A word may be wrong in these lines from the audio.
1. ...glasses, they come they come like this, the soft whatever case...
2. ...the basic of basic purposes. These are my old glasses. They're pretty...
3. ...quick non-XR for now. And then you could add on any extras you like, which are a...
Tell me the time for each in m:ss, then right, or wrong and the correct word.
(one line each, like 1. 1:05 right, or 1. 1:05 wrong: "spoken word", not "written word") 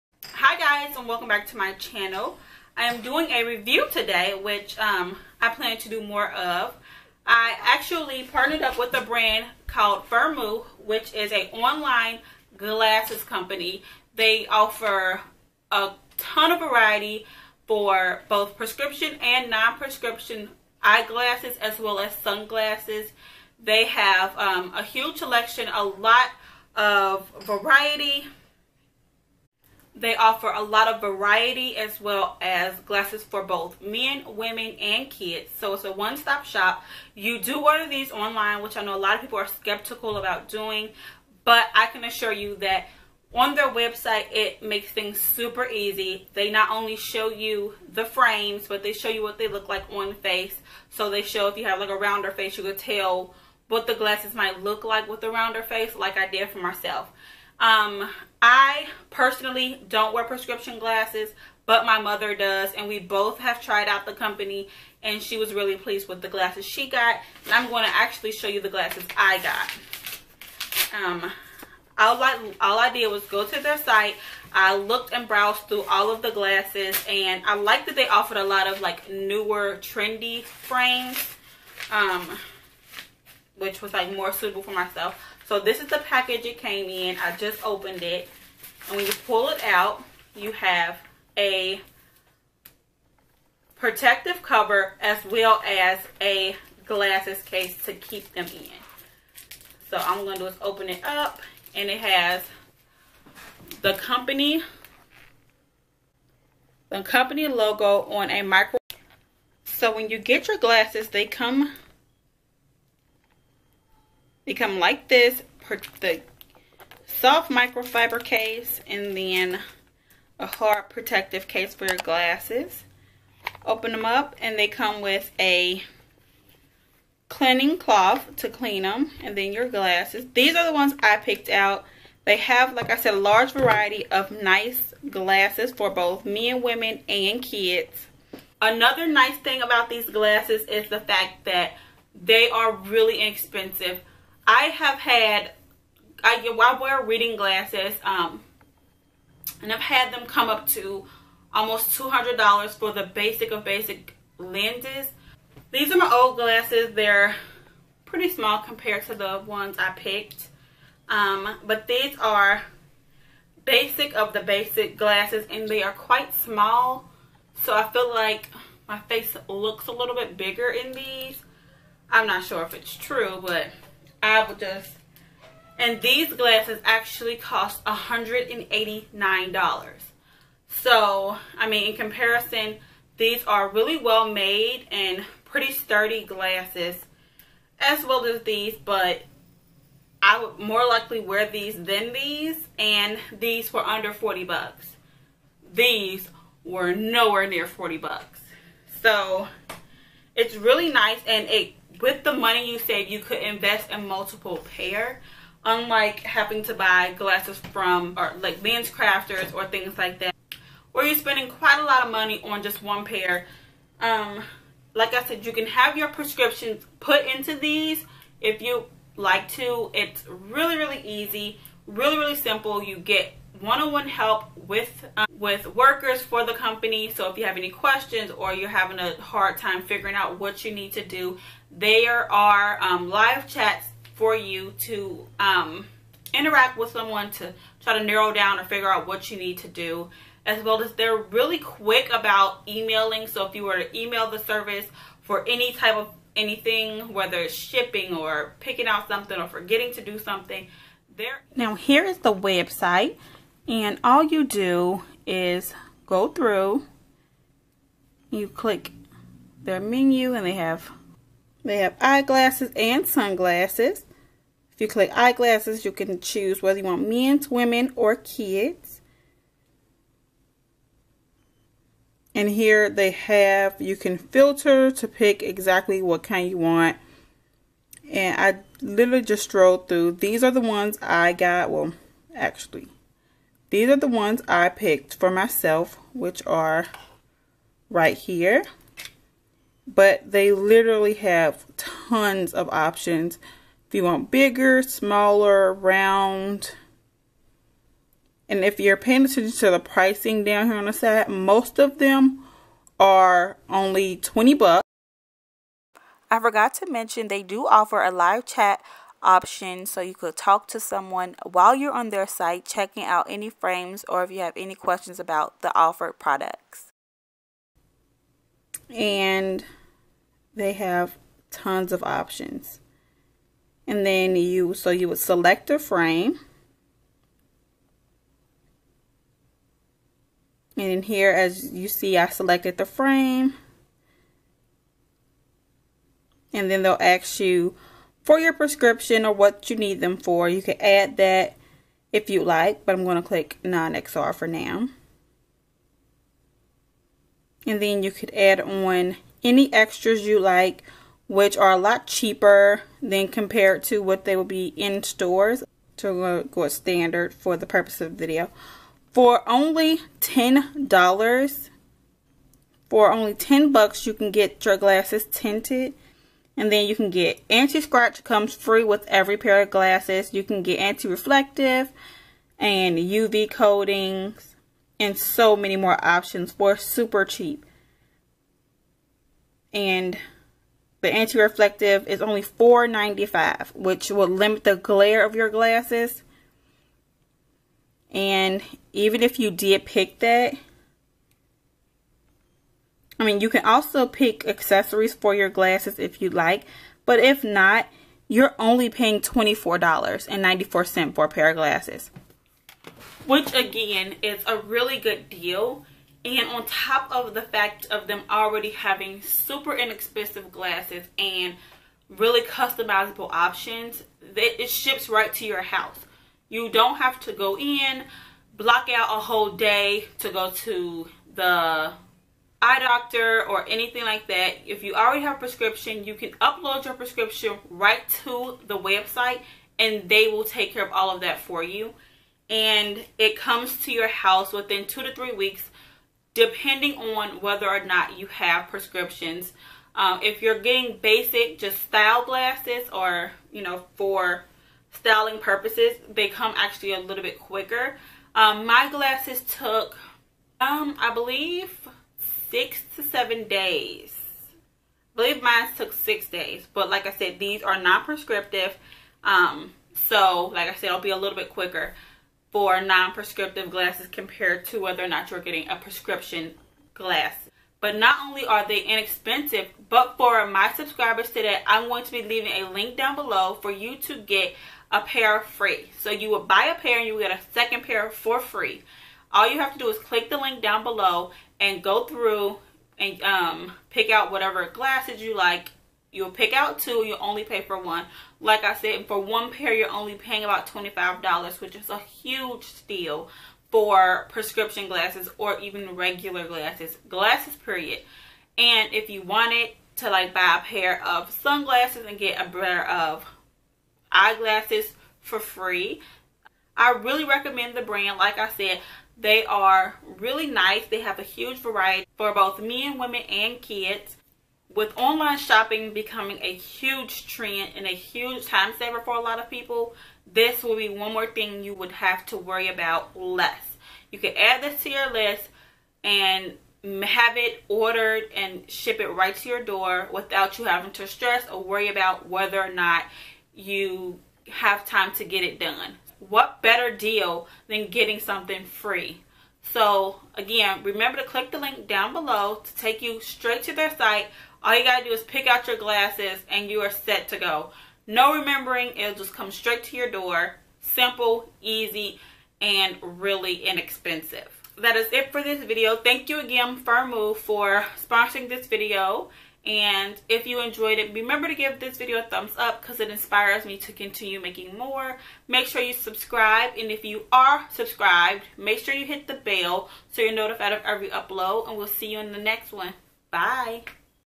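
1. 1:50 wrong: "microfiber", not "whatever"
2. 2:32 wrong: "lenses", not "purposes"
3. 5:43 wrong: "click", not "quick".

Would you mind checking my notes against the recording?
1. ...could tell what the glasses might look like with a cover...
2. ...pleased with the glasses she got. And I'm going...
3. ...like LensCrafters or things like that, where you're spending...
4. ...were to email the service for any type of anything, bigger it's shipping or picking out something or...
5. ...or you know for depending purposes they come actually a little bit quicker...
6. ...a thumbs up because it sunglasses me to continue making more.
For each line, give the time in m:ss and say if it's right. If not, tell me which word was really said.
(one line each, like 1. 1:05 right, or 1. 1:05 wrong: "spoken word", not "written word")
1. 0:52 wrong: "rounder", not "cover"
2. 1:05 right
3. 3:28 right
4. 4:03 wrong: "whether", not "bigger"
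5. 7:22 wrong: "styling", not "depending"
6. 9:22 wrong: "inspires", not "sunglasses".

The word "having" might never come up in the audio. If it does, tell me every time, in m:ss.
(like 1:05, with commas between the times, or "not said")
3:26, 3:48, 6:48, 8:50.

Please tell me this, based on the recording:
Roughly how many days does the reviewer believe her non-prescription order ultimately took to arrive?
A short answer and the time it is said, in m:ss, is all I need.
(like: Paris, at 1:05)
6 days, at 7:35.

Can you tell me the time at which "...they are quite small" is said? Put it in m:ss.
2:45.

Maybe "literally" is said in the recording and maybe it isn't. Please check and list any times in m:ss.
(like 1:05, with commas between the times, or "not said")
4:38, 4:50.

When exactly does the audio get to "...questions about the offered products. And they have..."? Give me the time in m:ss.
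5:14.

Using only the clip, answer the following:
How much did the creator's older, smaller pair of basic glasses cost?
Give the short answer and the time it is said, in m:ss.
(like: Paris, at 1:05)
$189, at 2:57.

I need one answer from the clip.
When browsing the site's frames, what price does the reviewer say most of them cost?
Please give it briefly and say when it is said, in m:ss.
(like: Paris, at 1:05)
20 bucks, at 5:04.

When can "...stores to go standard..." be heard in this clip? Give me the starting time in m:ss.
5:55.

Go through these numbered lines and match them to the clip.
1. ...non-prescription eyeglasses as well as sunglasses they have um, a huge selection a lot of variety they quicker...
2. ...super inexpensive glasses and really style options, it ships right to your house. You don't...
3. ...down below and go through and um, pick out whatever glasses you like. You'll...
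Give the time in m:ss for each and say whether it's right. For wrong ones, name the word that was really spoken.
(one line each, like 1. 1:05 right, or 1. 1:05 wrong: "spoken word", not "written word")
1. 0:19 wrong: "offer", not "quicker"
2. 6:49 wrong: "customizable", not "style"
3. 8:00 right.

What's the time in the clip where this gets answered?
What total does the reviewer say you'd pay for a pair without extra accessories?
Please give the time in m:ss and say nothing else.
6:39.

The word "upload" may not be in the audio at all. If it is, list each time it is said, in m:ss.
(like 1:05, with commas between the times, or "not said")
7:06, 9:31.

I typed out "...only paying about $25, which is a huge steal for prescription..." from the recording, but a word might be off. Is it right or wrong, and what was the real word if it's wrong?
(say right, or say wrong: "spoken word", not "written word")
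right.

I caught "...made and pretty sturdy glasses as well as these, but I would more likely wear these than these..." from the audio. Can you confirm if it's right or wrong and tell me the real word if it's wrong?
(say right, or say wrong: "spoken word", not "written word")
right.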